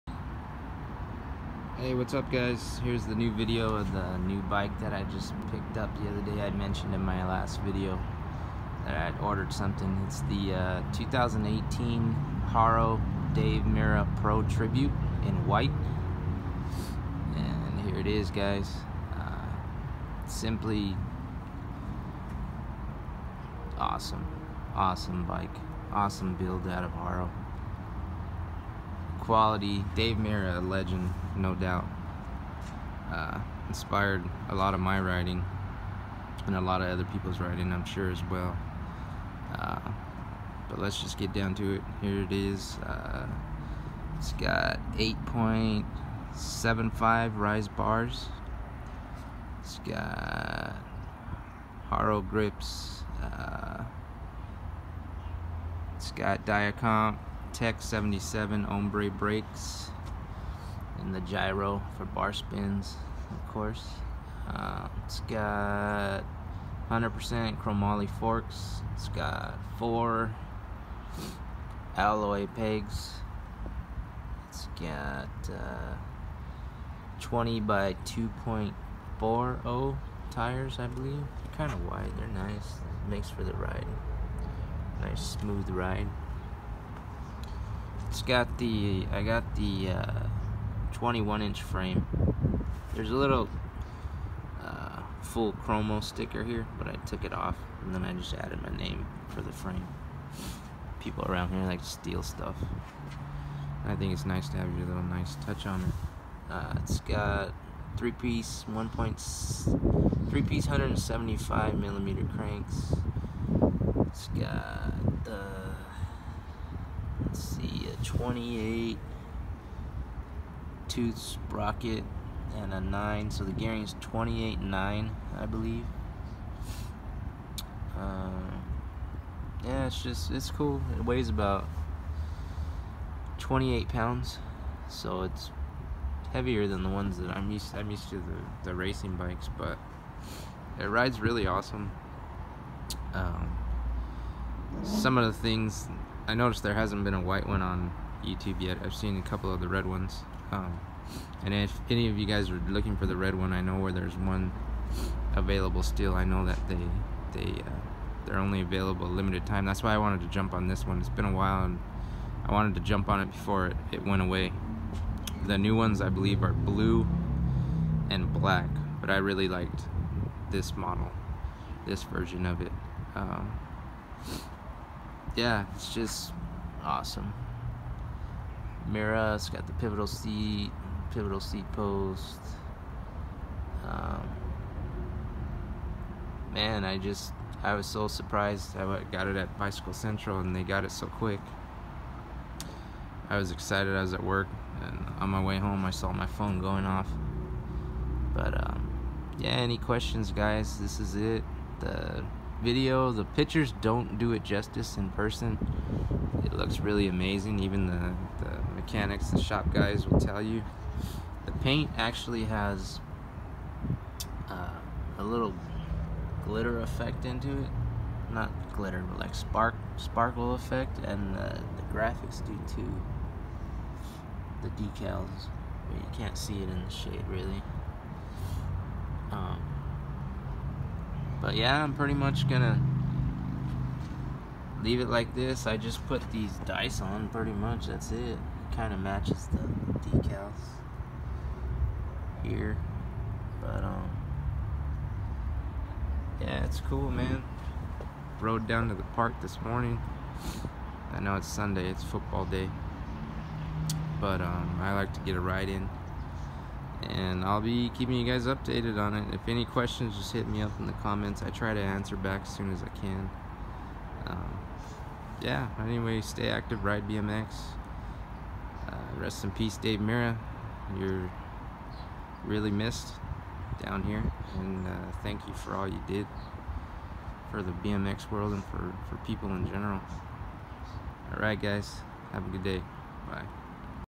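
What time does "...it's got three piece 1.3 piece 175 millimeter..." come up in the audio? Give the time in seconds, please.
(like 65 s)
106 s.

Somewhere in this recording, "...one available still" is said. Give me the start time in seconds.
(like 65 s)
154 s.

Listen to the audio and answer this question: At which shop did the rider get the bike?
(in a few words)
Bicycle Central.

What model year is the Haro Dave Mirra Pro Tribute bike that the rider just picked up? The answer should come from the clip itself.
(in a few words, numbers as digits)
2018.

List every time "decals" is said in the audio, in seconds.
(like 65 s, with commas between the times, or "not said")
224 s, 240 s.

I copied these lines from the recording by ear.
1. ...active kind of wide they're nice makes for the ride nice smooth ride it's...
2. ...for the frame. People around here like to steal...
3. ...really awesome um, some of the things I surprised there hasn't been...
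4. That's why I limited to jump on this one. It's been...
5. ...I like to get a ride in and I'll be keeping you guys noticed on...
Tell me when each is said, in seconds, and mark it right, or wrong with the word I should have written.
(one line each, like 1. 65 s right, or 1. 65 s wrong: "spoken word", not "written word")
1. 80 s wrong: "believe", not "active"
2. 99 s right
3. 141 s wrong: "noticed", not "surprised"
4. 159 s wrong: "wanted", not "limited"
5. 254 s wrong: "updated", not "noticed".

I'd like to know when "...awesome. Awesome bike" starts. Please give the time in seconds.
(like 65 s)
23 s.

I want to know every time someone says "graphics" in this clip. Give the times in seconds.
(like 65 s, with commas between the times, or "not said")
221 s.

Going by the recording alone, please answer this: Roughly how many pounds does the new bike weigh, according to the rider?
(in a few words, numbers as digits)
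28 pounds.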